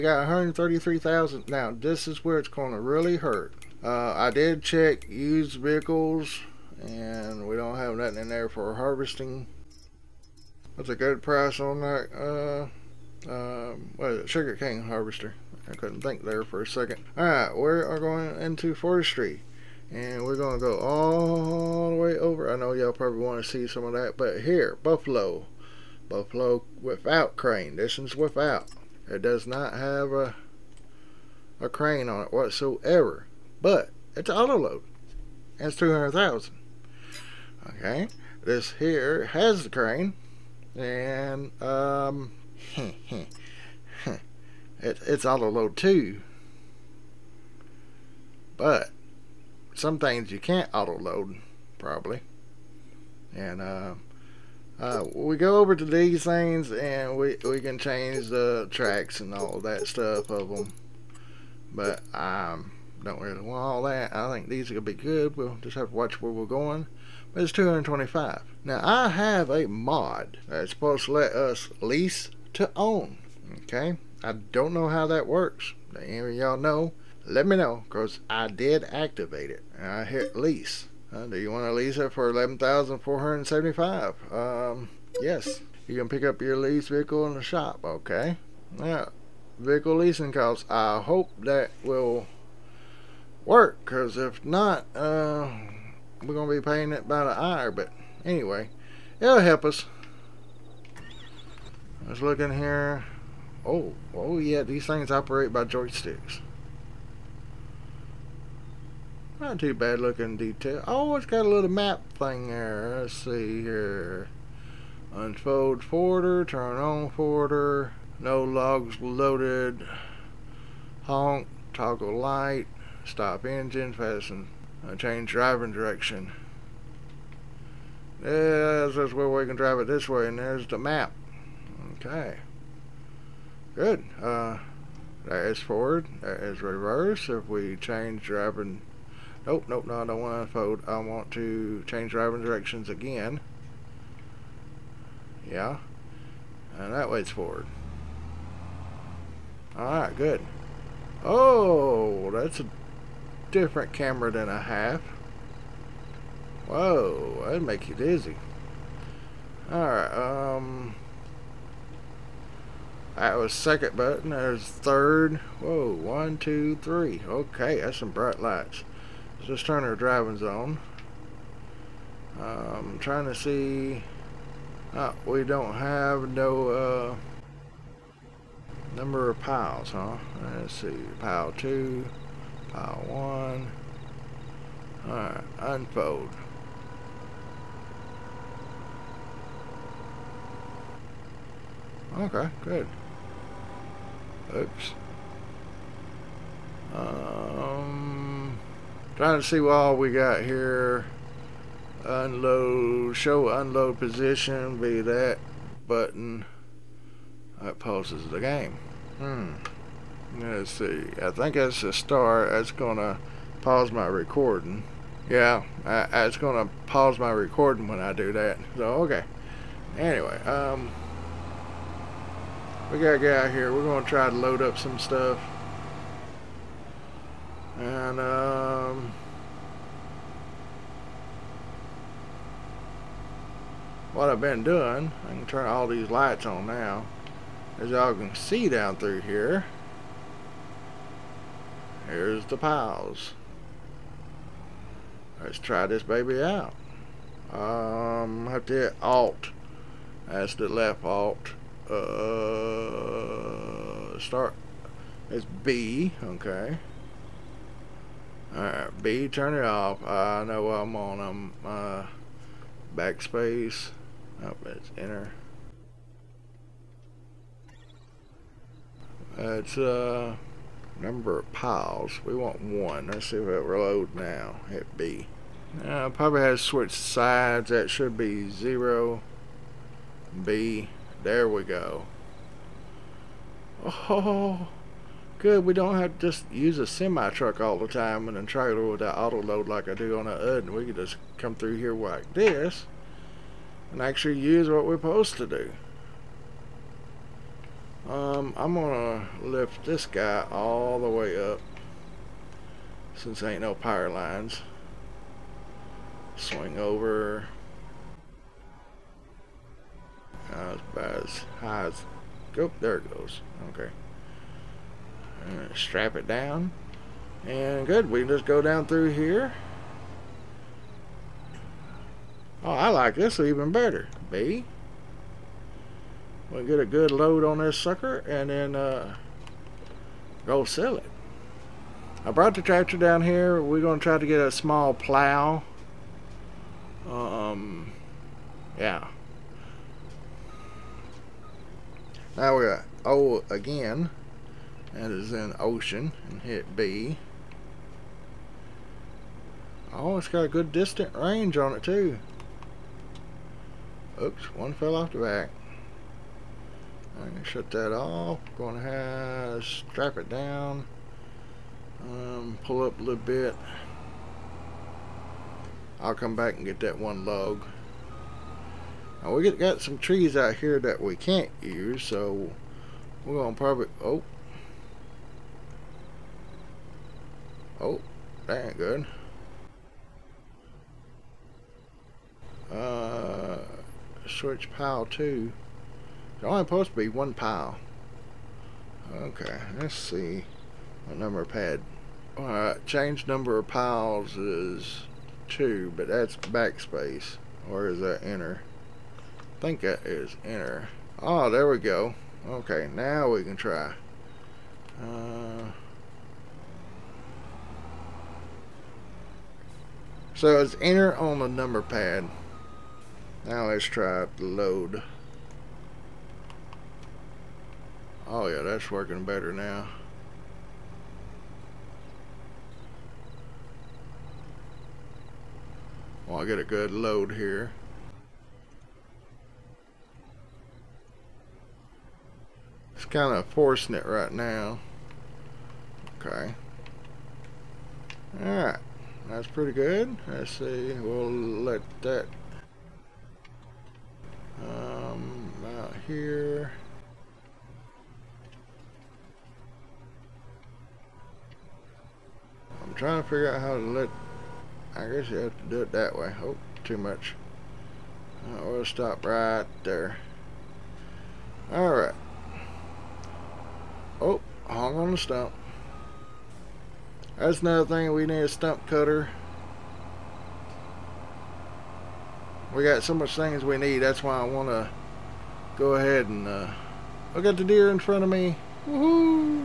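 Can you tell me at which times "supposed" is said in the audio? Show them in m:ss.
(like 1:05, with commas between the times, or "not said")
1:10, 4:54, 6:26.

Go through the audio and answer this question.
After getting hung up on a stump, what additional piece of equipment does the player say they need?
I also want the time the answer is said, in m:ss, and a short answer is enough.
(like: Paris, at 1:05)
Stump cutter, at 7:48.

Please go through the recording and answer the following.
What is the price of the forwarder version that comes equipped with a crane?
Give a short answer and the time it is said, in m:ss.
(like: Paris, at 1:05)
225,000, at 1:07.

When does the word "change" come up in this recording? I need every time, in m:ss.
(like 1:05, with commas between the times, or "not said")
0:57, 2:04, 2:17, 2:21, 6:32.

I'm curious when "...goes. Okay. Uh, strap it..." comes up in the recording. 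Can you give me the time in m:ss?
5:13.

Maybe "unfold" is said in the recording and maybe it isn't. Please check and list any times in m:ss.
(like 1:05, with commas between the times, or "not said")
1:55, 2:20, 3:05.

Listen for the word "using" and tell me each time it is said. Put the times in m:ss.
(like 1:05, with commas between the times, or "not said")
not said.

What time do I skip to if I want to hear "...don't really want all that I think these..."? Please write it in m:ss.
1:03.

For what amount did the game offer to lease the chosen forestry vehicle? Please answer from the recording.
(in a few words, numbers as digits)
11,475.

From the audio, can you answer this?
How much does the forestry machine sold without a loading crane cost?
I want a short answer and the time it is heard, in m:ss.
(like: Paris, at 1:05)
200,000, at 0:35.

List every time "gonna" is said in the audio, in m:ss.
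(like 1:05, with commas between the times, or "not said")
1:04, 1:36, 4:58, 6:13.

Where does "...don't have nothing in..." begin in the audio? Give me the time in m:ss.
0:07.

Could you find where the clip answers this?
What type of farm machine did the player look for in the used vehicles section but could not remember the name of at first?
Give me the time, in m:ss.
0:14.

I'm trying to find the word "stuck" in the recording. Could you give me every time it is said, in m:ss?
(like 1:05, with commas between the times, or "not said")
not said.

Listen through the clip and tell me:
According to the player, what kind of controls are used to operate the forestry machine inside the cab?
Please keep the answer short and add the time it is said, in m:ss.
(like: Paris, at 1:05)
Joysticks, at 1:45.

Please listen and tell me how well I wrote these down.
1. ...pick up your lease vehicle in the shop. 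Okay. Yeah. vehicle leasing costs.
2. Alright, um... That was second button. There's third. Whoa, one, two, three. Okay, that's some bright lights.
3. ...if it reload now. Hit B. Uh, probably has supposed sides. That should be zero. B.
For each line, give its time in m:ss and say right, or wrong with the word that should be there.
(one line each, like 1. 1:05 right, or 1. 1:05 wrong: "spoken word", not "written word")
1. 1:26 right
2. 2:39 right
3. 4:33 wrong: "switched", not "supposed".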